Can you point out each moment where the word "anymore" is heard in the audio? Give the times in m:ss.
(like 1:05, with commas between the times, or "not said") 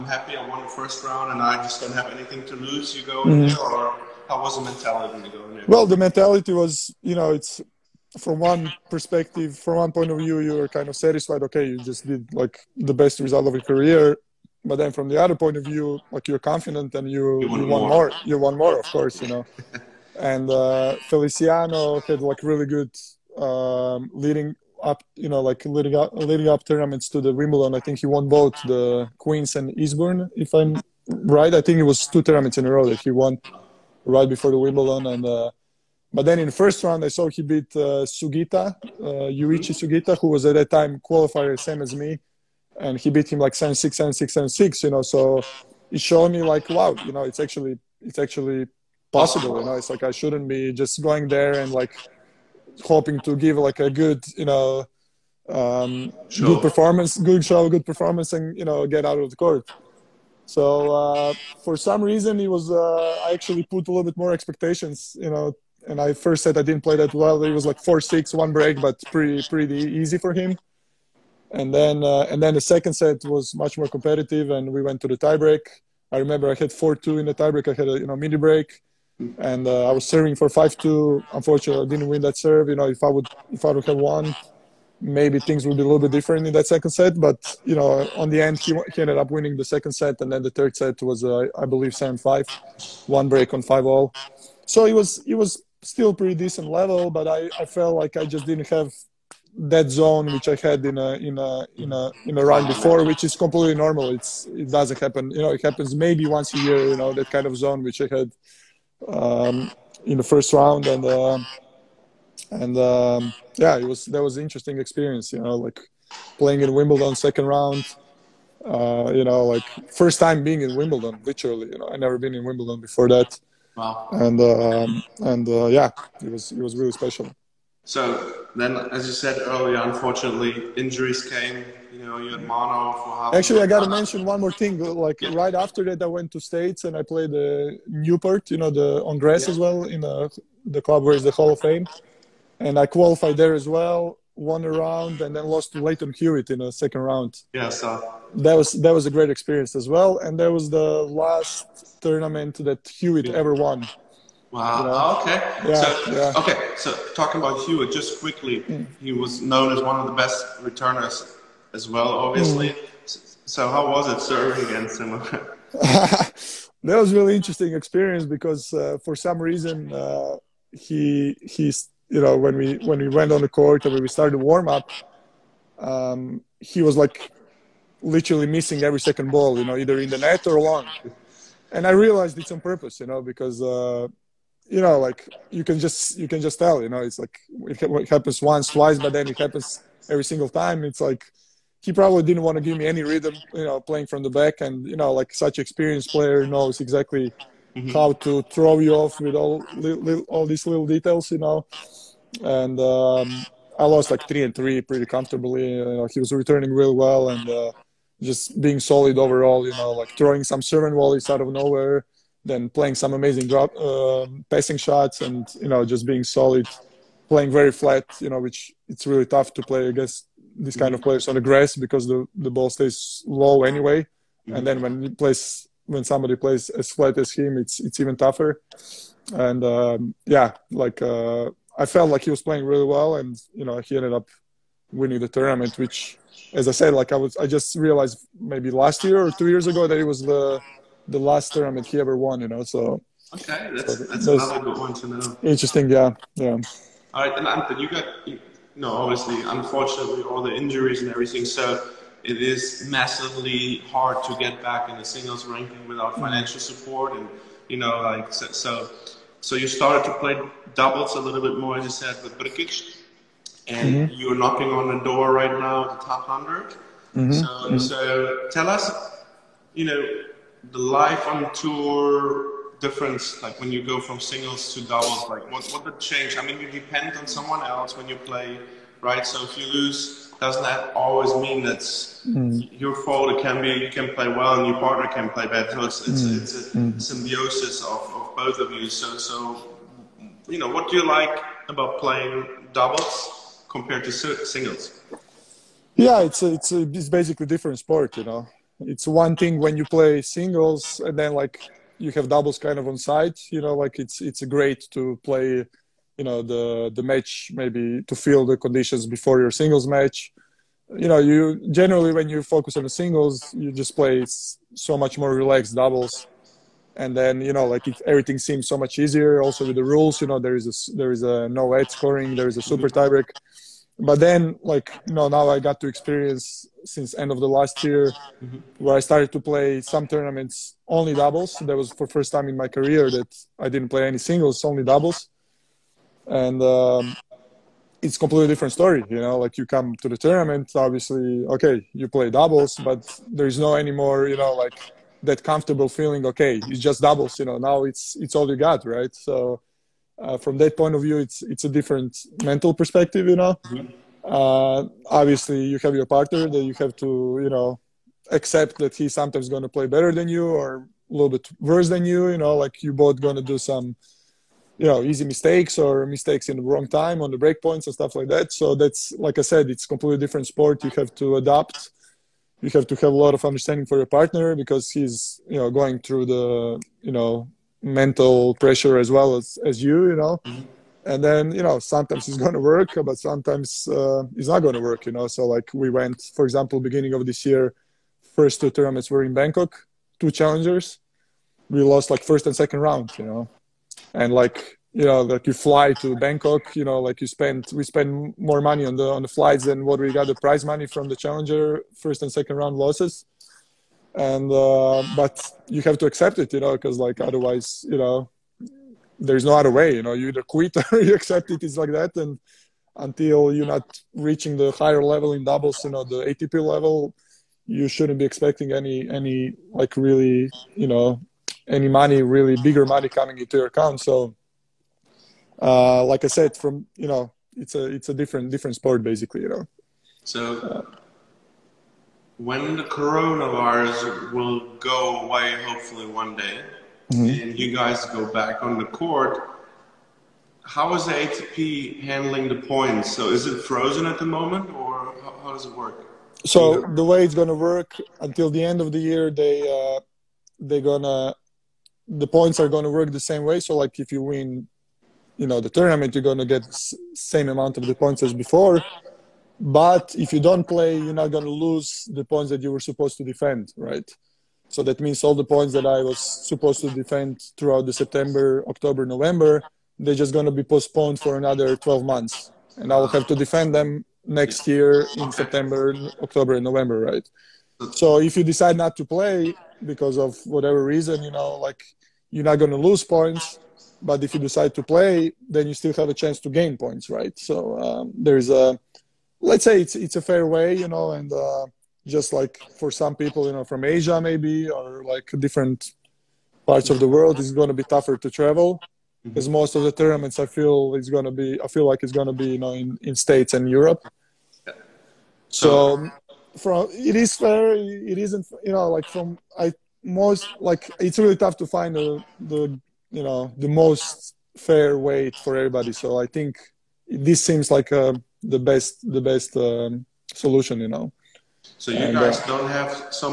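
5:43.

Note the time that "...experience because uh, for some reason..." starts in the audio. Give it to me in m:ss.
2:47.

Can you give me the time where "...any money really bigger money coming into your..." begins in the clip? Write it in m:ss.
7:01.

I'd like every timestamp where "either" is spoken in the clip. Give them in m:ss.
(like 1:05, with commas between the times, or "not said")
2:59, 6:50.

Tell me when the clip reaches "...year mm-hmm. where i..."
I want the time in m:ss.
5:27.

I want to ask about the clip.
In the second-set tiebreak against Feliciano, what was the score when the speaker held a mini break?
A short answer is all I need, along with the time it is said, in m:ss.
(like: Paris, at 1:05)
4-2, at 1:16.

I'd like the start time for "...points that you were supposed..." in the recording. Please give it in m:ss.
7:42.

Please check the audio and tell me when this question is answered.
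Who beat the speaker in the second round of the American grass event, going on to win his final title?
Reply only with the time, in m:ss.
2:25.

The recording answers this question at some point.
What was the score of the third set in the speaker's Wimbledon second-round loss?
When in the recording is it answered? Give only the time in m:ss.
1:31.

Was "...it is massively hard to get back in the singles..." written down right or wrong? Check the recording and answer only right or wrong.
right.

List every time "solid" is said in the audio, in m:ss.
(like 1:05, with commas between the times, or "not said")
3:28, 3:36.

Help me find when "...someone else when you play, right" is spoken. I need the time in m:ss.
4:37.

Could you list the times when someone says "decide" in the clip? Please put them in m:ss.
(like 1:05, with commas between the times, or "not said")
7:58, 8:04.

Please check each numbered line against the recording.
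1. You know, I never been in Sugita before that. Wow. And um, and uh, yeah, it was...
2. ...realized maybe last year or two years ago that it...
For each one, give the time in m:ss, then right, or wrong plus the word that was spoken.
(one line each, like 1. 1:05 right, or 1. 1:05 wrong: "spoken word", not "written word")
1. 2:01 wrong: "Wimbledon", not "Sugita"
2. 3:57 right.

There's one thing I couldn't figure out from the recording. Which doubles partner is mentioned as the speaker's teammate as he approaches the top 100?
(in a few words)
Brkic.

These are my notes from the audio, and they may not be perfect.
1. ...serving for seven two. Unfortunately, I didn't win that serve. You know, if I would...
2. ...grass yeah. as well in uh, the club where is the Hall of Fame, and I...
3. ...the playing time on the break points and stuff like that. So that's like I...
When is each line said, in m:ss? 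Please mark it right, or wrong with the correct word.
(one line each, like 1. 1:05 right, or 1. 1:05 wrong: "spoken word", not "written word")
1. 1:20 wrong: "five", not "seven"
2. 2:19 right
3. 6:06 wrong: "wrong", not "playing".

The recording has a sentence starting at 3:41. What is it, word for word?
players on the grass because the, the ball stays low anyway mm-hmm.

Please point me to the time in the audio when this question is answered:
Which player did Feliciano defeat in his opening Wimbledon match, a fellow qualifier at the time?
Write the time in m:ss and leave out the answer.
0:39.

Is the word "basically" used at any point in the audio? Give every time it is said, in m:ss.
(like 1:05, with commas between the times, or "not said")
4:57, 7:09.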